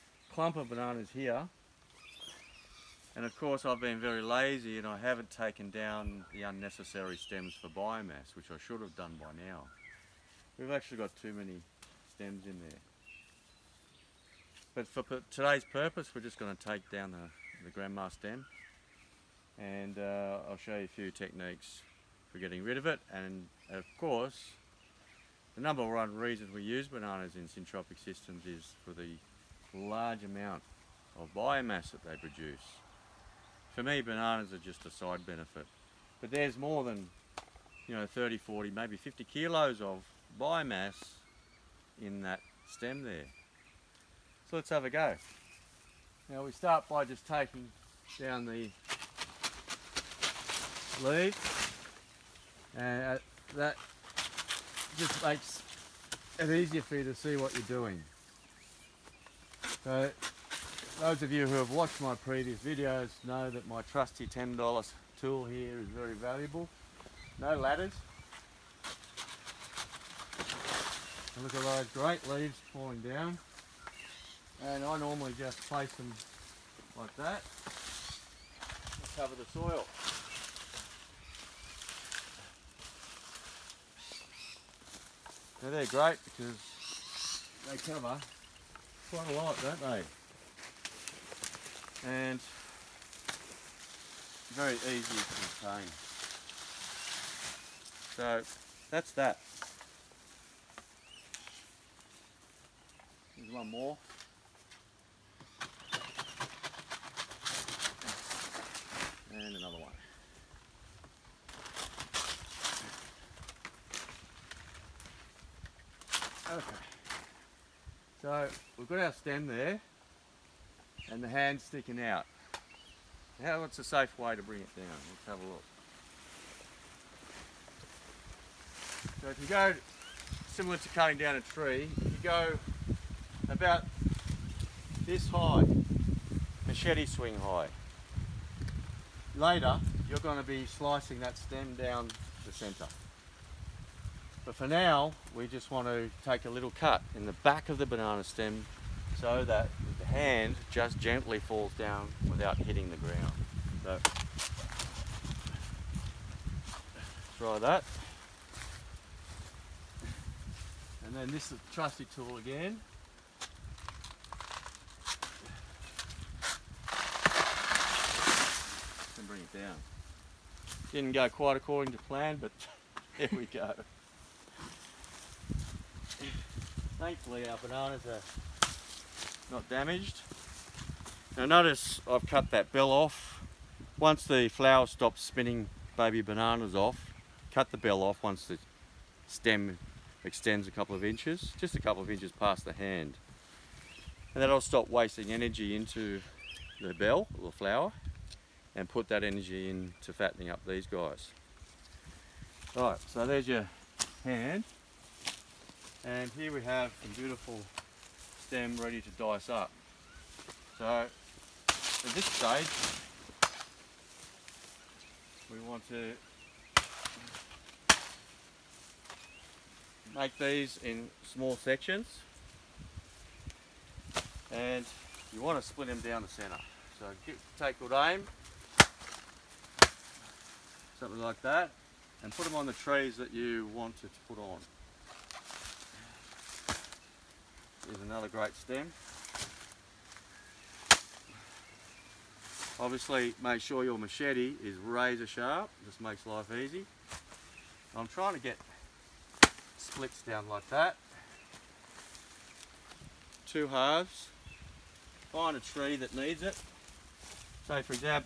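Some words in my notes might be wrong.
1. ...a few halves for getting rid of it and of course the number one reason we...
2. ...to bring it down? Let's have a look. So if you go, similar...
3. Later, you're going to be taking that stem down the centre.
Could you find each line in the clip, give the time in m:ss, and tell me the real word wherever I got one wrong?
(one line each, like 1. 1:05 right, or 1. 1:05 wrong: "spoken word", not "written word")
1. 0:20 wrong: "techniques", not "halves"
2. 2:04 right
3. 2:19 wrong: "slicing", not "taking".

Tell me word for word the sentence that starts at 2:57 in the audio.
Thankfully our bananas are not damaged.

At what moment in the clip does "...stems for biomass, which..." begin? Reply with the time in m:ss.
0:07.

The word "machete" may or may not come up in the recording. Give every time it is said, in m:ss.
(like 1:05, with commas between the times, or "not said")
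2:16, 4:03.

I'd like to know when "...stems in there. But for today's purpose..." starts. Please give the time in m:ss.
0:12.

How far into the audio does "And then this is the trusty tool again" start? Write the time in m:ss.
2:41.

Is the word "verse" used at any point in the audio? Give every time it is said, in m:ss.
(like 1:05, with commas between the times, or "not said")
not said.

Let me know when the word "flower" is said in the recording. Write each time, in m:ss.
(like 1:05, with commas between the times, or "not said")
3:04, 3:17.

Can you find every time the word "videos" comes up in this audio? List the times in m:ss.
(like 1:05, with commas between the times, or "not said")
1:02.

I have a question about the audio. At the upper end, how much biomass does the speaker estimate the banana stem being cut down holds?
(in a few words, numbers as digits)
50 kilos.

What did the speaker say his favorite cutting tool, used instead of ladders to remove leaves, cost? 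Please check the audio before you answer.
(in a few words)
$10.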